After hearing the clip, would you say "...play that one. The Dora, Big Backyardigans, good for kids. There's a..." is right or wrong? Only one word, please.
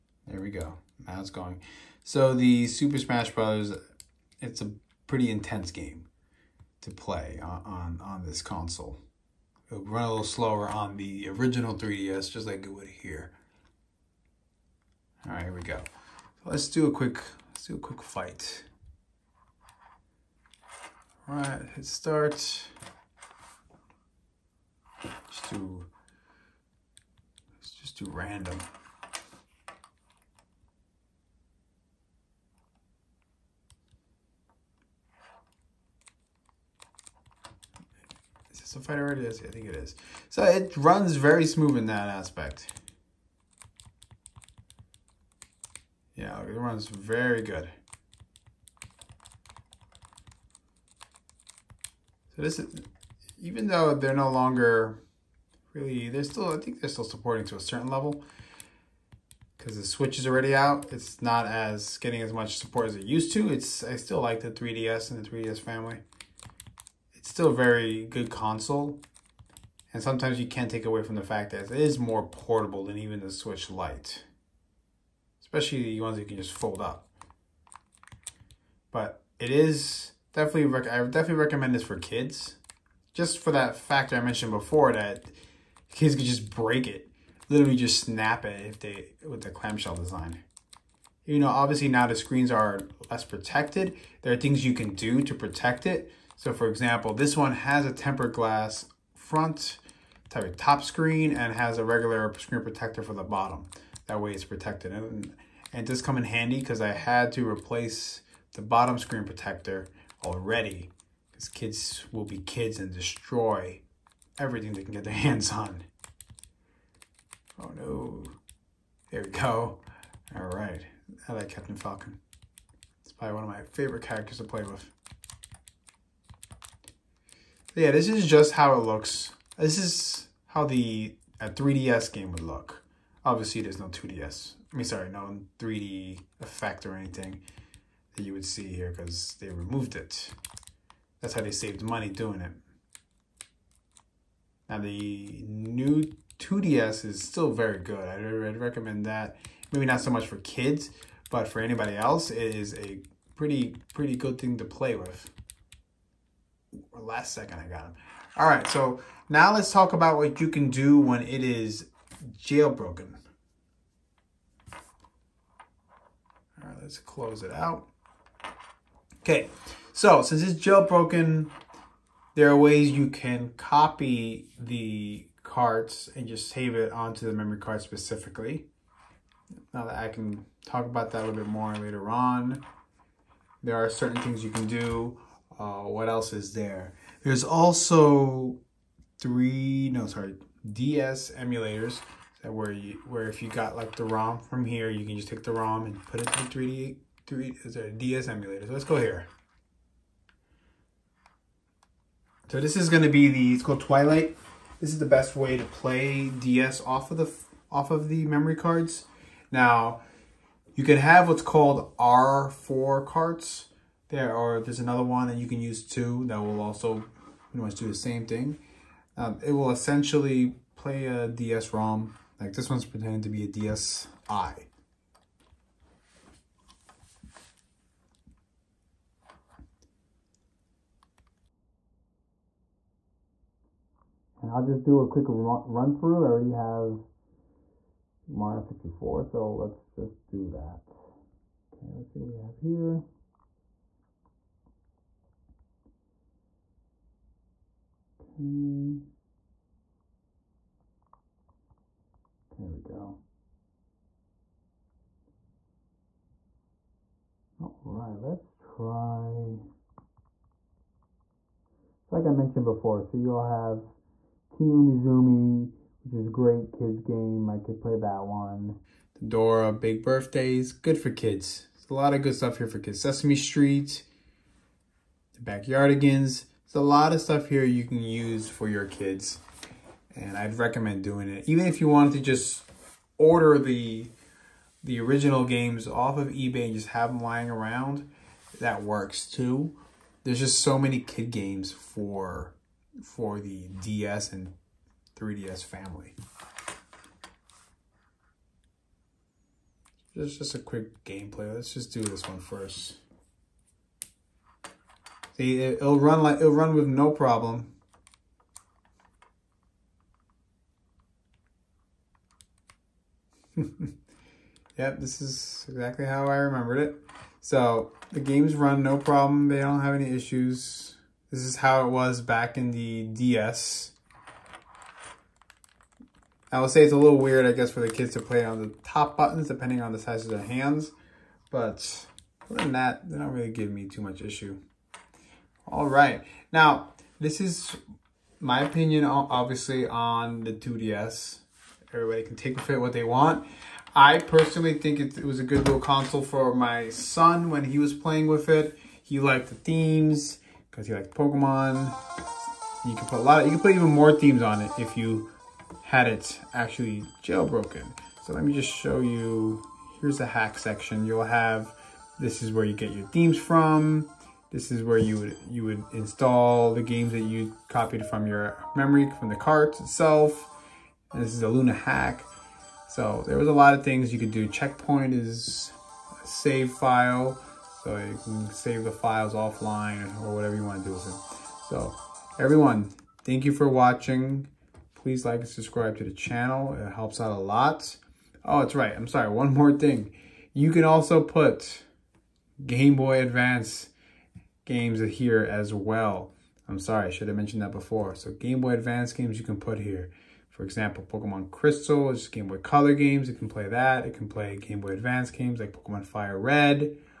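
wrong.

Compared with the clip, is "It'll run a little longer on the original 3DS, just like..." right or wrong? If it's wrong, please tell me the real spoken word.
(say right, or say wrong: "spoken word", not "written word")
wrong: "slower", not "longer".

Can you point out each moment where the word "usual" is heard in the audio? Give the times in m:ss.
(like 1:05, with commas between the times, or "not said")
not said.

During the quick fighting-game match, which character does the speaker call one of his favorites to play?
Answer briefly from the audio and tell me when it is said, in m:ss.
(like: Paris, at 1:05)
Captain Falcon, at 2:01.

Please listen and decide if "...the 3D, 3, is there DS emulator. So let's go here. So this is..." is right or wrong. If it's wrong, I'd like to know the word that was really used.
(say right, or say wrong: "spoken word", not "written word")
right.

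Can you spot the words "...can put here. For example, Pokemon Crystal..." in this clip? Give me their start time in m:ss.
6:39.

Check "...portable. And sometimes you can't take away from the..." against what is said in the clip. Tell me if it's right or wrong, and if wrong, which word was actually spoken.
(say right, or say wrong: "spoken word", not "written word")
wrong: "console", not "portable".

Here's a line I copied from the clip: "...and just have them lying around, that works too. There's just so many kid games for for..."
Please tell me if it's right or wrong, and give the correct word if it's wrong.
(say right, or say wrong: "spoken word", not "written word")
right.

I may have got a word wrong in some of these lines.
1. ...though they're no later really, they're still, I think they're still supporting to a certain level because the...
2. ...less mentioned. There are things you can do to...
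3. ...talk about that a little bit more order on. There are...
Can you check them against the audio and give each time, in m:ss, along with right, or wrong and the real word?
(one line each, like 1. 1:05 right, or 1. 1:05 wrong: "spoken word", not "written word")
1. 0:53 wrong: "longer", not "later"
2. 1:33 wrong: "protected", not "mentioned"
3. 3:00 wrong: "later", not "order".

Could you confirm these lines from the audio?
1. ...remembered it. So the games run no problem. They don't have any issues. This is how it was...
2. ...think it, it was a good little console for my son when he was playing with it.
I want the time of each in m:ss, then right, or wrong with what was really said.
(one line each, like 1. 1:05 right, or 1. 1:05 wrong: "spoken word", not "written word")
1. 5:16 right
2. 5:44 right.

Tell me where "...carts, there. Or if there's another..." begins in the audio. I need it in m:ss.
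3:33.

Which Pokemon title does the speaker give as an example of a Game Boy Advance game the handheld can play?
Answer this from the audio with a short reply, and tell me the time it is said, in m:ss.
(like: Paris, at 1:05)
Pokemon Fire Red, at 6:45.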